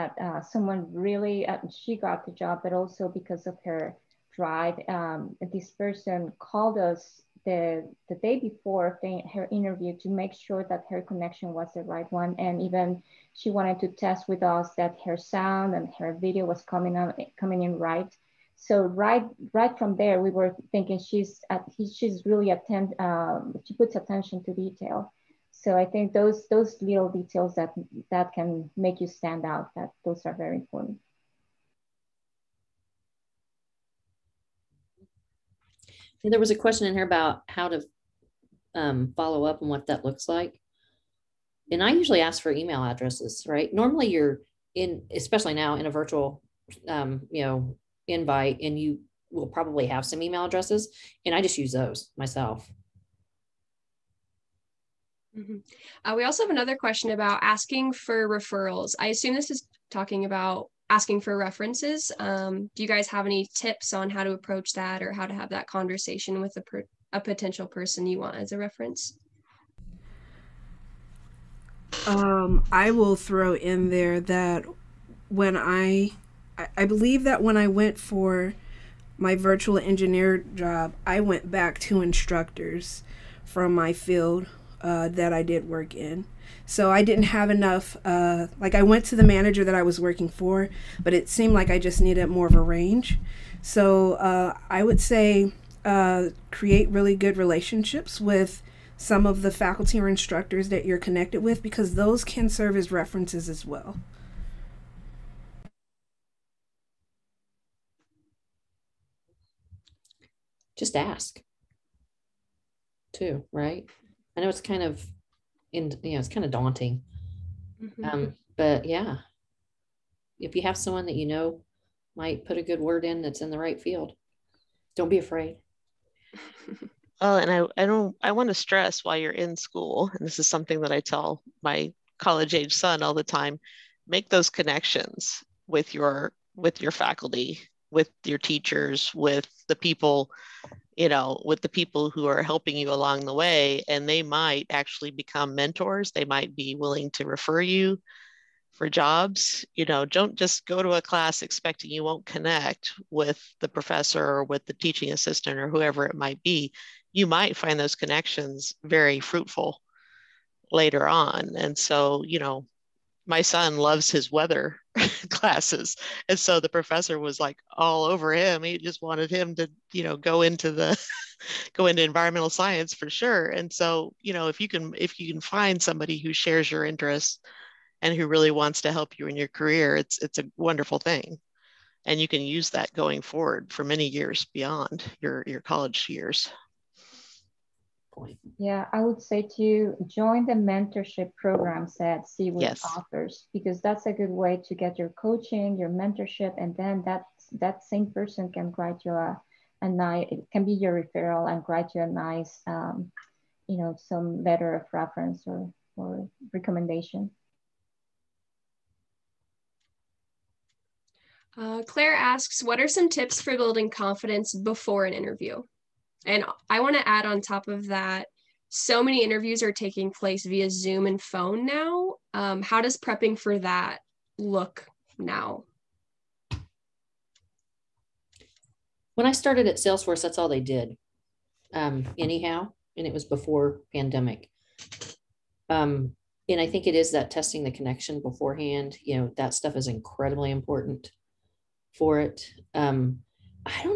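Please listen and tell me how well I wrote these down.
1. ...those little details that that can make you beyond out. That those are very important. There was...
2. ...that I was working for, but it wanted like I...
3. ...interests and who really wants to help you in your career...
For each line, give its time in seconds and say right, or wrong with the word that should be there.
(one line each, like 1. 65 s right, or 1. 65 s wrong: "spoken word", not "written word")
1. 26 s wrong: "stand", not "beyond"
2. 89 s wrong: "seemed", not "wanted"
3. 176 s right.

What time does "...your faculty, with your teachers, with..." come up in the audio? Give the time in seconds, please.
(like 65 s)
136 s.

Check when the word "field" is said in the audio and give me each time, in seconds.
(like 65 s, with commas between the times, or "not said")
83 s, 123 s.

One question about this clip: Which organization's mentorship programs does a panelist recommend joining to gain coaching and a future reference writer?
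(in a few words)
CEWIT.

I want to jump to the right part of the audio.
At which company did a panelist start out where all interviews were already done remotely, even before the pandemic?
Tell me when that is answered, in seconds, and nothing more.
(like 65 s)
229 s.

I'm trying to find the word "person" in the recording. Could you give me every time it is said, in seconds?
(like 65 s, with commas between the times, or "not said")
5 s, 67 s, 198 s.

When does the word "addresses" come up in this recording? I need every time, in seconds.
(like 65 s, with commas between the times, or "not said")
42 s, 50 s.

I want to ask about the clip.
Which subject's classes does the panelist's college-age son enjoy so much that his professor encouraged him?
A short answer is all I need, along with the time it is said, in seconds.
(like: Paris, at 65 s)
Weather, at 164 s.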